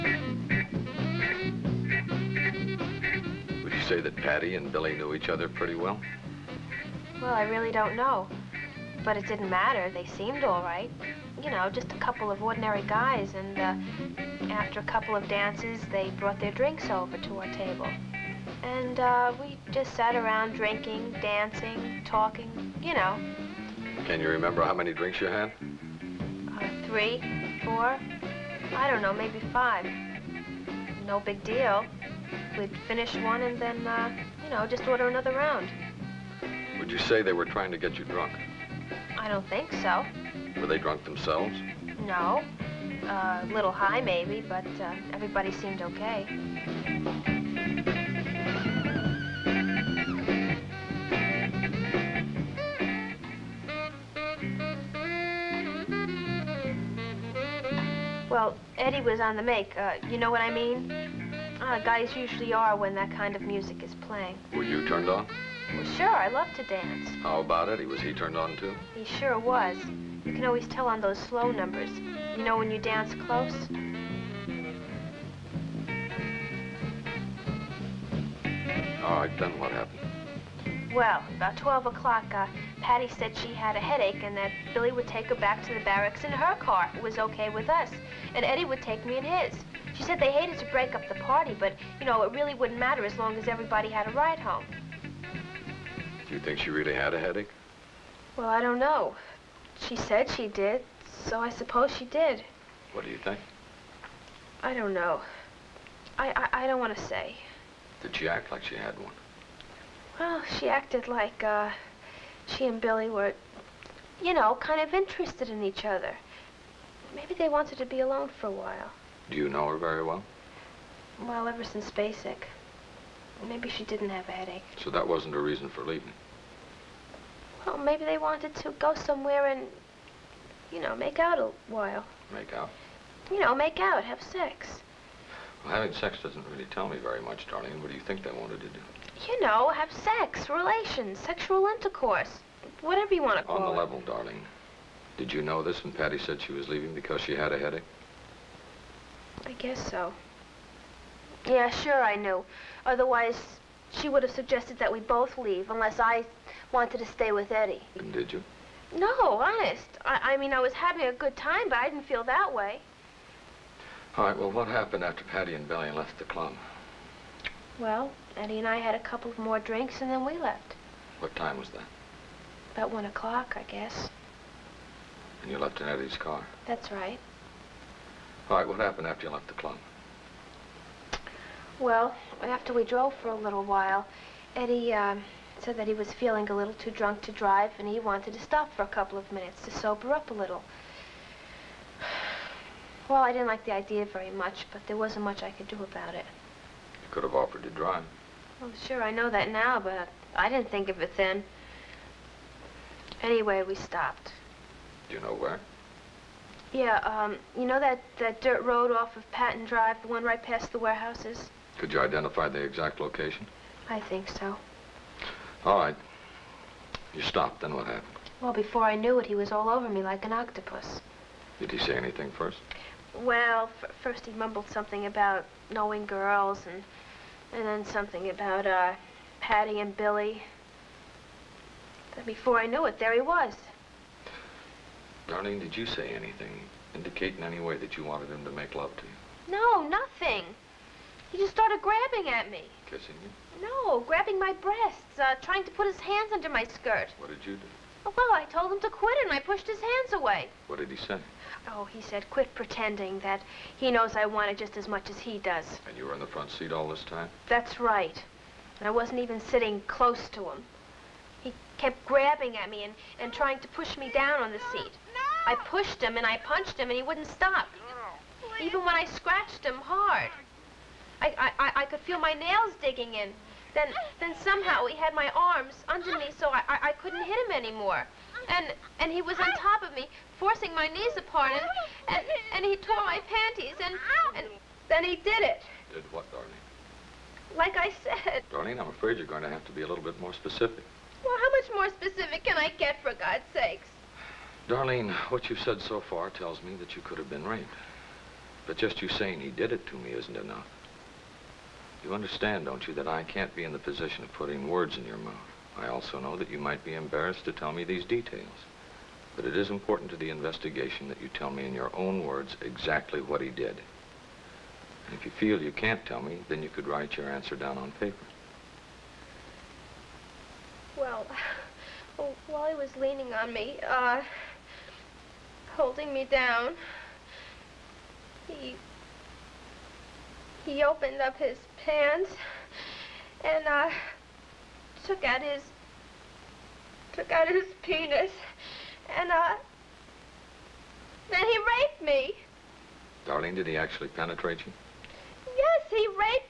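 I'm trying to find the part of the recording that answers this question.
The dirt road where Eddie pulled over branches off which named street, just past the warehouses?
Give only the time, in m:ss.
3:29.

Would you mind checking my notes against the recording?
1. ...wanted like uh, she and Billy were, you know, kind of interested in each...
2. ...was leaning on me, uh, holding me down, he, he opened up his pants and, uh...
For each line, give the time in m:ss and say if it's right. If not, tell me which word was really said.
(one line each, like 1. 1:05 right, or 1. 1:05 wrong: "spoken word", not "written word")
1. 1:50 wrong: "acted", not "wanted"
2. 5:22 right.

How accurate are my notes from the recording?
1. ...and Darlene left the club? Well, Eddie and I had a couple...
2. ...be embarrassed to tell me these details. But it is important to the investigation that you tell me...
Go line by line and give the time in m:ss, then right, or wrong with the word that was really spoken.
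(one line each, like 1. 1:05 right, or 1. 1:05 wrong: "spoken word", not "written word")
1. 2:45 wrong: "Billy", not "Darlene"
2. 5:06 right.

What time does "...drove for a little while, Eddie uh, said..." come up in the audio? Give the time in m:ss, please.
3:02.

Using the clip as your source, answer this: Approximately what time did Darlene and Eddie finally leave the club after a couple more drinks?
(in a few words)
1 o'clock.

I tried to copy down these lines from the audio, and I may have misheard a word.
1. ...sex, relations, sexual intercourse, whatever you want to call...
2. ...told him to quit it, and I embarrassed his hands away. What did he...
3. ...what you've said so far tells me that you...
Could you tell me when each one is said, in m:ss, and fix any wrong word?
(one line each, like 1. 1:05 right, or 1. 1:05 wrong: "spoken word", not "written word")
1. 2:19 right
2. 4:08 wrong: "pushed", not "embarrassed"
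3. 4:55 right.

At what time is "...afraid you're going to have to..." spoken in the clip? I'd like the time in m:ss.
4:48.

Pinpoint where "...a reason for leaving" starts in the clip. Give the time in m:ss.
2:05.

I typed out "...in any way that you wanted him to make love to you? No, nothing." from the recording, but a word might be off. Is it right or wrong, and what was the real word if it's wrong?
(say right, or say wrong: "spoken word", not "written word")
right.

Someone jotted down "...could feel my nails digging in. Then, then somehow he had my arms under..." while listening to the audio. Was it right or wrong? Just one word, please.
right.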